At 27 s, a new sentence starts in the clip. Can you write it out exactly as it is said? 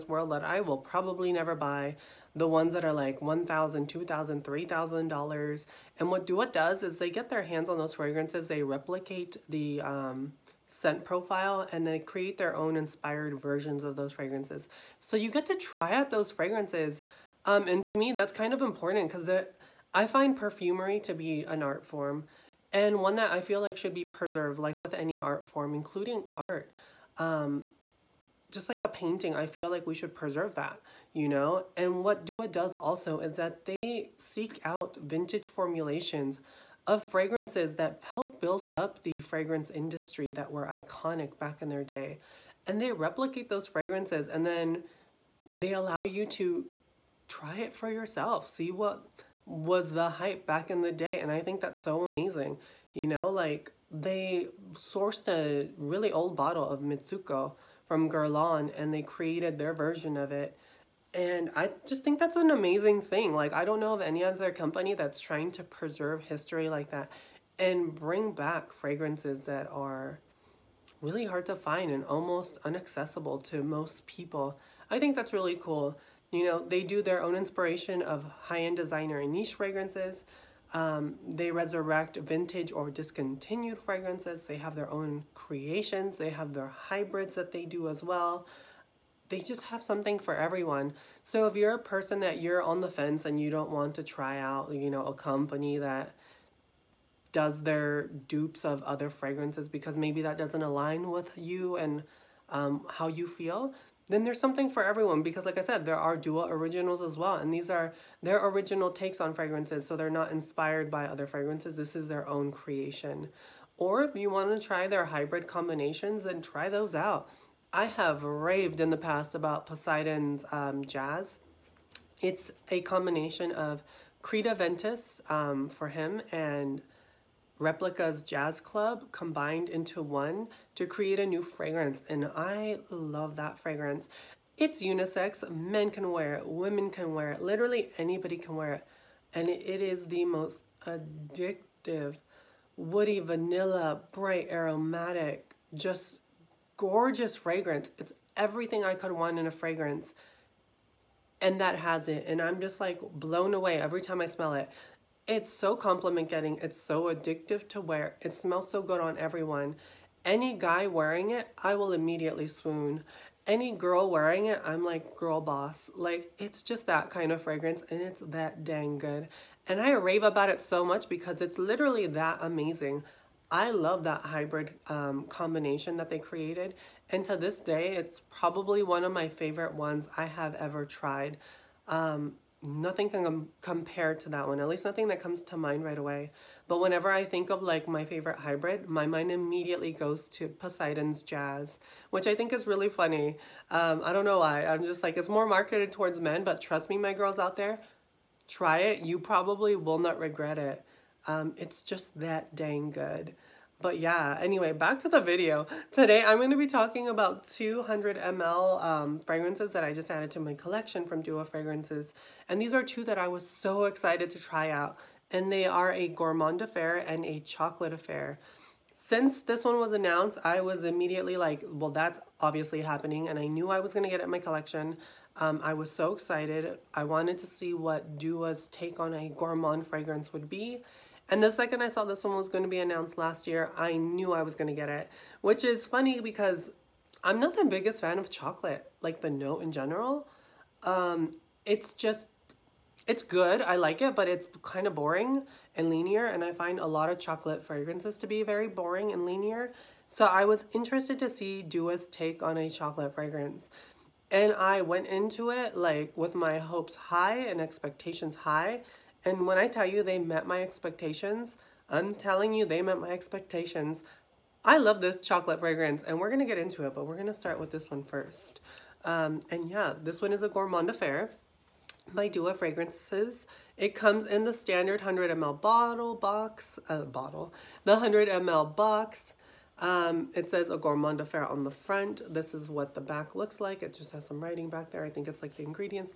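Um, just like a painting, I feel like we should preserve that, you know?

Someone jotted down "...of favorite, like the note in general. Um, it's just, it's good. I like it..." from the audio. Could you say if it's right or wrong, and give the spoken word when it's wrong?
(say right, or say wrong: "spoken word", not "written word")
wrong: "chocolate", not "favorite".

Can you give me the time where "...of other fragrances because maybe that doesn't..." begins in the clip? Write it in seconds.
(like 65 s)
98 s.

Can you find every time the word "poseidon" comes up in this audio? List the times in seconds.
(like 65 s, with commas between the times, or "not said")
119 s, 190 s.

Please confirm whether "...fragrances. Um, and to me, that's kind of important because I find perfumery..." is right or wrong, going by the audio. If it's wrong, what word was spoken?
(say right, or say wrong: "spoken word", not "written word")
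right.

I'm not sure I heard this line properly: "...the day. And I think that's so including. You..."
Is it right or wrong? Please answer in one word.
wrong.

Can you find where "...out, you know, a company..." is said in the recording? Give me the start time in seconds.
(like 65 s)
94 s.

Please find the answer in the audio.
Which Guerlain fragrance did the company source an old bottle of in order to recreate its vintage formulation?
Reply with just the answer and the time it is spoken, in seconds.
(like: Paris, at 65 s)
Mitsouko, at 56 s.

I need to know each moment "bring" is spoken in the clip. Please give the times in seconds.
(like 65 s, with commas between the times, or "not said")
67 s.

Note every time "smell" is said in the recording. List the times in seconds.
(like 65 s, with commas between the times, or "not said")
154 s, 158 s.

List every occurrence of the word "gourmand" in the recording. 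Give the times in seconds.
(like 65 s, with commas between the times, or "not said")
216 s, 229 s, 270 s, 280 s.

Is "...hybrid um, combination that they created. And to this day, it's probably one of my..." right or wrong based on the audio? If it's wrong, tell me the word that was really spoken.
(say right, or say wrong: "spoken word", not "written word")
right.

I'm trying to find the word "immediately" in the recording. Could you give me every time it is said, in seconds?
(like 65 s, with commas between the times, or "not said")
161 s, 189 s, 220 s.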